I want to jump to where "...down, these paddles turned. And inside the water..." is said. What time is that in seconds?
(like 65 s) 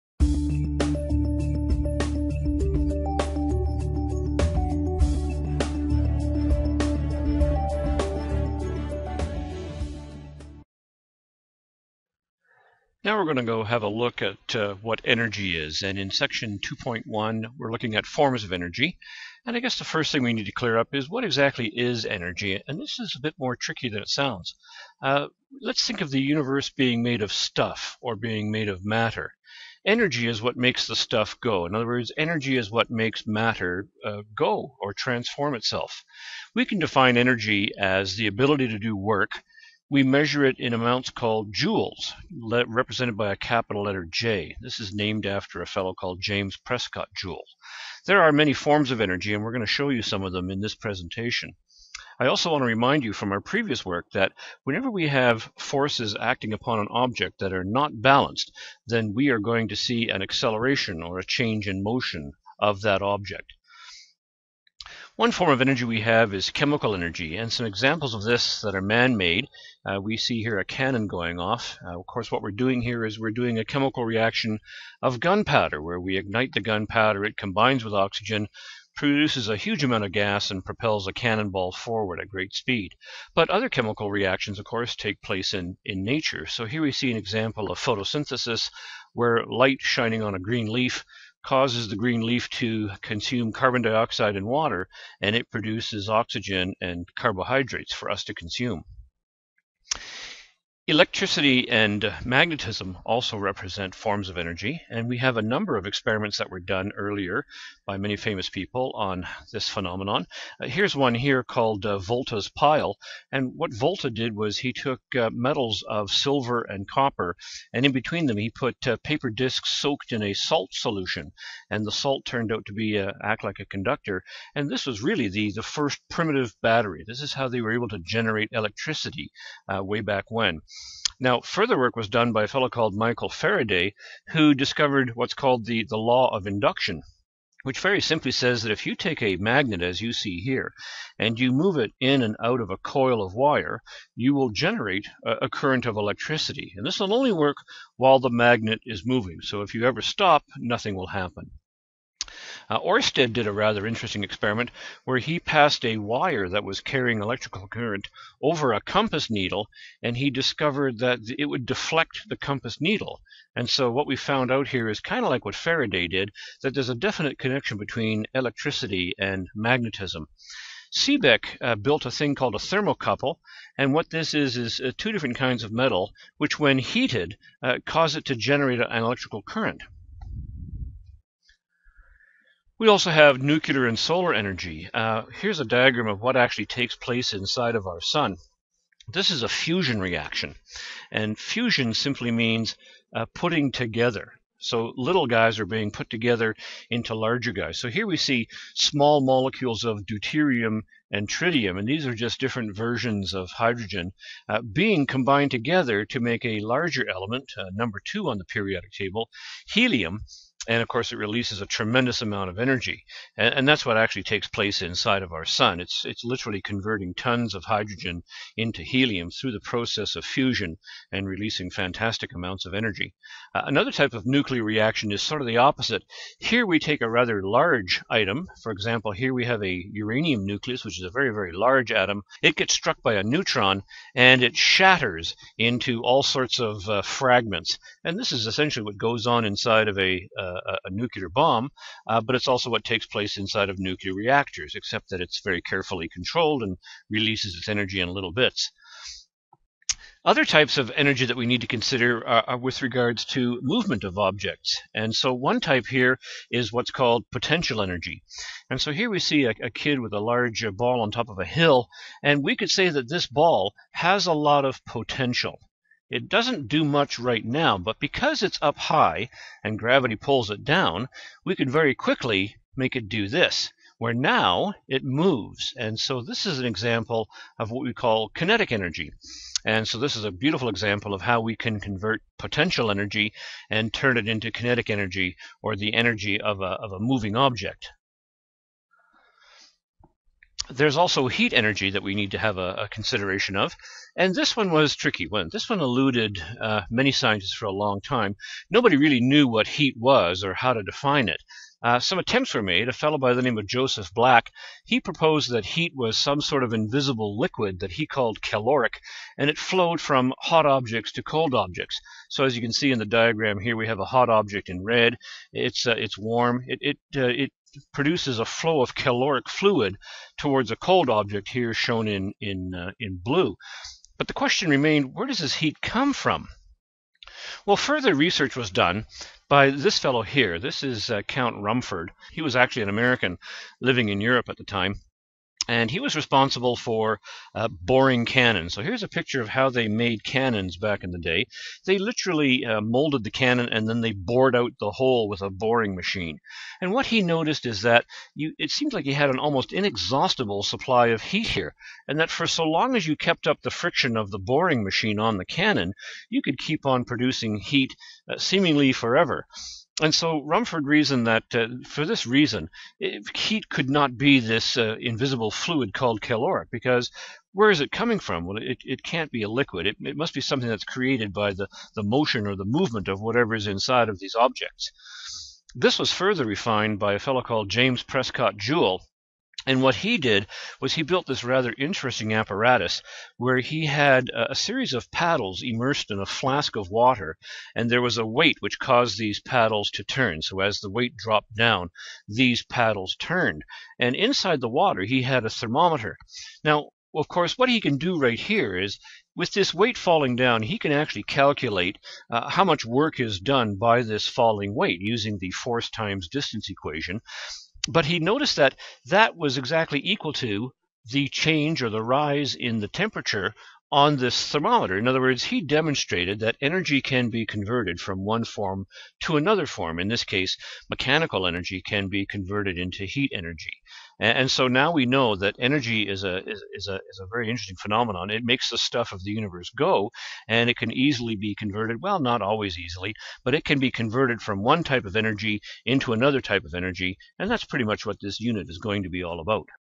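391 s.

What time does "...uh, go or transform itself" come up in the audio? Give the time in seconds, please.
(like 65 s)
34 s.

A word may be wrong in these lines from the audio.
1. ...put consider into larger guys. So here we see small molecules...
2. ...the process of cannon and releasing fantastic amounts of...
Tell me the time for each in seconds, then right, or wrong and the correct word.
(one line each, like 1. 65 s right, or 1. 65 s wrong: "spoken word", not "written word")
1. 195 s wrong: "together", not "consider"
2. 219 s wrong: "fusion", not "cannon".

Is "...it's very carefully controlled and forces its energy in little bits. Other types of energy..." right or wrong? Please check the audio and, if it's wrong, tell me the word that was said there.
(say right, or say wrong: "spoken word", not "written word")
wrong: "releases", not "forces".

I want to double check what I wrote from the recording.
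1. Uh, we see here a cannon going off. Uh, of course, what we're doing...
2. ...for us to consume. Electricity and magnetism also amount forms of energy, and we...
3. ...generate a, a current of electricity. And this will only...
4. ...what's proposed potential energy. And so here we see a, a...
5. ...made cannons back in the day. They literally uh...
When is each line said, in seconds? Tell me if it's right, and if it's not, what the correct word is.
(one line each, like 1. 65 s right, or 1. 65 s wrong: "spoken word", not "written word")
1. 69 s right
2. 97 s wrong: "represent", not "amount"
3. 144 s right
4. 256 s wrong: "called", not "proposed"
5. 339 s right.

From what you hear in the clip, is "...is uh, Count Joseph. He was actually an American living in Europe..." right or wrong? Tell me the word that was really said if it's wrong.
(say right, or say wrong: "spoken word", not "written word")
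wrong: "Rumford", not "Joseph".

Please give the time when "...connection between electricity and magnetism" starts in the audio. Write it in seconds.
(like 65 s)
167 s.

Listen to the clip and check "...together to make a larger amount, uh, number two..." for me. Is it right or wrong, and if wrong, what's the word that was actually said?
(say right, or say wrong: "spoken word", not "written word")
wrong: "element", not "amount".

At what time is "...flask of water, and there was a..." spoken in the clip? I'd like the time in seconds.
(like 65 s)
386 s.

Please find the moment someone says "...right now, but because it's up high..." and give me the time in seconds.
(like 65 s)
267 s.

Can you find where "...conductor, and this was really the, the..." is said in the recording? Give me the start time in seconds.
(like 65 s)
123 s.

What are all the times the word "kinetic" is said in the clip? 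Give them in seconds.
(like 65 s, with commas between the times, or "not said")
278 s, 284 s.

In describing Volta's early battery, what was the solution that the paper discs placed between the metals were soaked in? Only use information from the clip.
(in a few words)
salt solution.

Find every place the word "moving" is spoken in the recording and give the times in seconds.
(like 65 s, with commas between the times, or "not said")
149 s, 286 s.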